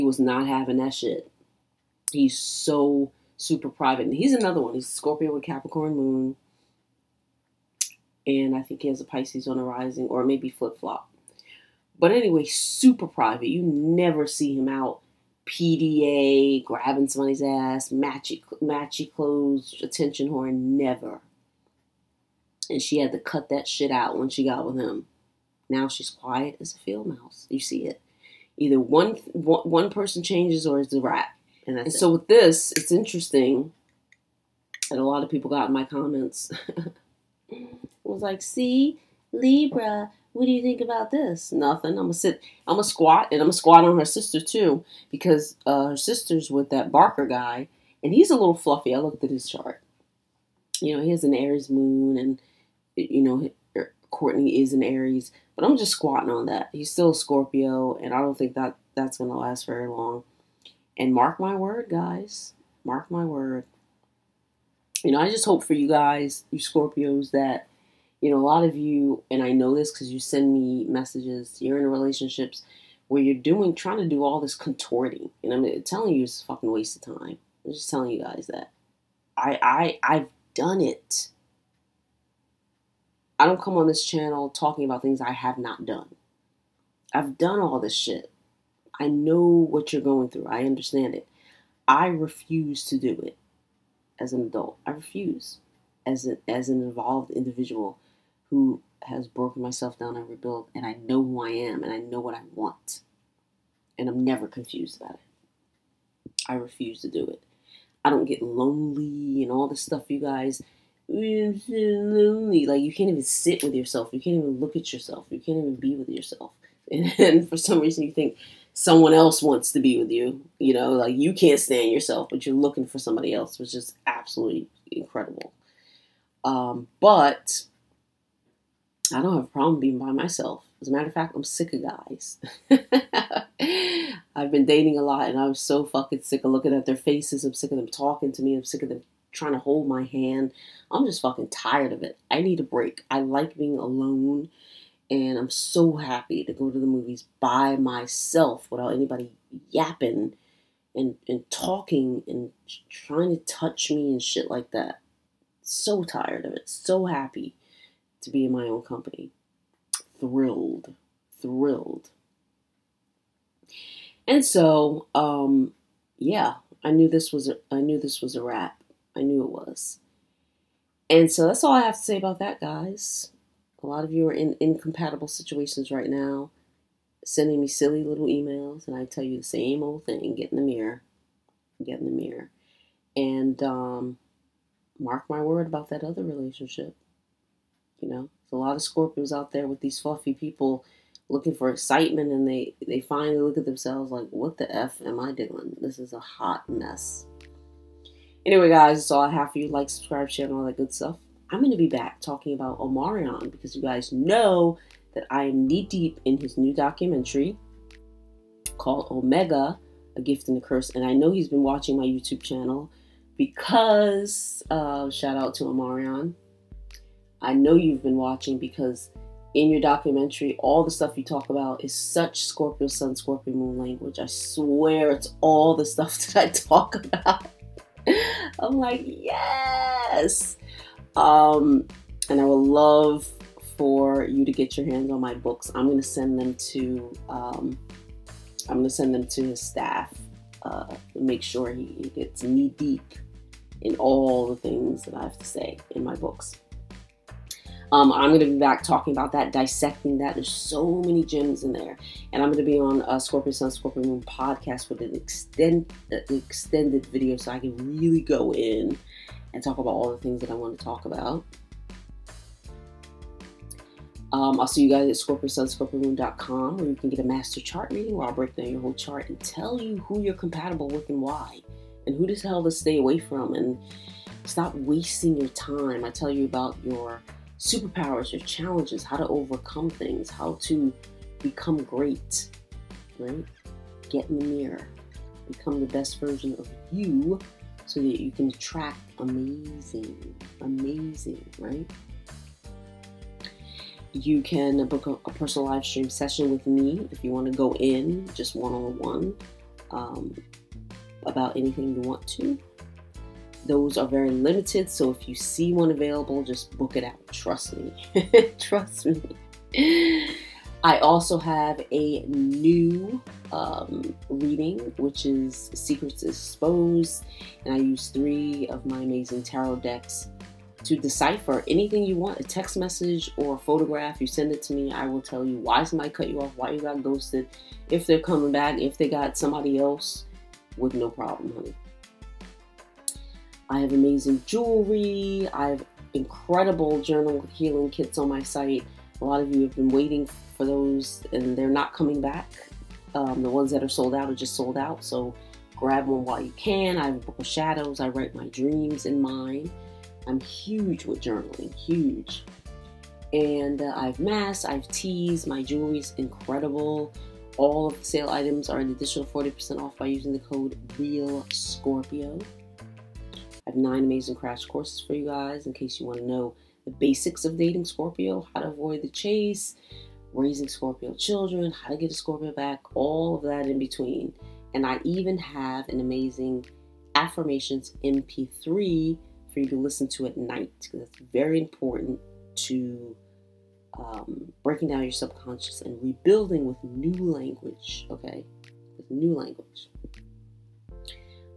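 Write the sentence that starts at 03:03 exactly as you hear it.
And um, mark my word about that other relationship.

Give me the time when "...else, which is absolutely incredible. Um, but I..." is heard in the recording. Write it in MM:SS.
02:03.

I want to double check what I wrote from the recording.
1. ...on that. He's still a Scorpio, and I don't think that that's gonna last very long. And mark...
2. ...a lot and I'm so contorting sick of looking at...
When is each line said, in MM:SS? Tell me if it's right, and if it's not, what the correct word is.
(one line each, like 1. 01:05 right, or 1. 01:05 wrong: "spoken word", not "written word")
1. 00:56 right
2. 02:14 wrong: "fucking", not "contorting".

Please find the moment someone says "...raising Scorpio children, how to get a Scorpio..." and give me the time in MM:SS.
06:10.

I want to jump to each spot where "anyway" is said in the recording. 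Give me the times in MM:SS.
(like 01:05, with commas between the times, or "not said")
00:12, 03:18.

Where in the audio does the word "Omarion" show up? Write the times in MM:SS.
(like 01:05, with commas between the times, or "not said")
03:22, 03:35.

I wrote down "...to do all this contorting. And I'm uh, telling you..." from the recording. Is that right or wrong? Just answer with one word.
right.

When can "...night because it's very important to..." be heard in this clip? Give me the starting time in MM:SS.
06:20.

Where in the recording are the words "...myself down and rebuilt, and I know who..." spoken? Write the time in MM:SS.
01:39.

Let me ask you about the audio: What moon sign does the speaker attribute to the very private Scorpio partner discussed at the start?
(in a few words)
Capricorn.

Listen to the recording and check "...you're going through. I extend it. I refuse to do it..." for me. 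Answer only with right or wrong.
wrong.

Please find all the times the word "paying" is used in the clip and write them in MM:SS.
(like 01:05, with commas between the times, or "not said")
not said.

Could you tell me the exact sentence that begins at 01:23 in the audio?
I don't come on this channel talking about things I have not done.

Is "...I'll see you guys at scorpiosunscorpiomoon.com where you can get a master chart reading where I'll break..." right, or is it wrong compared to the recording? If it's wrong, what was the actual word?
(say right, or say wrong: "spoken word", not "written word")
right.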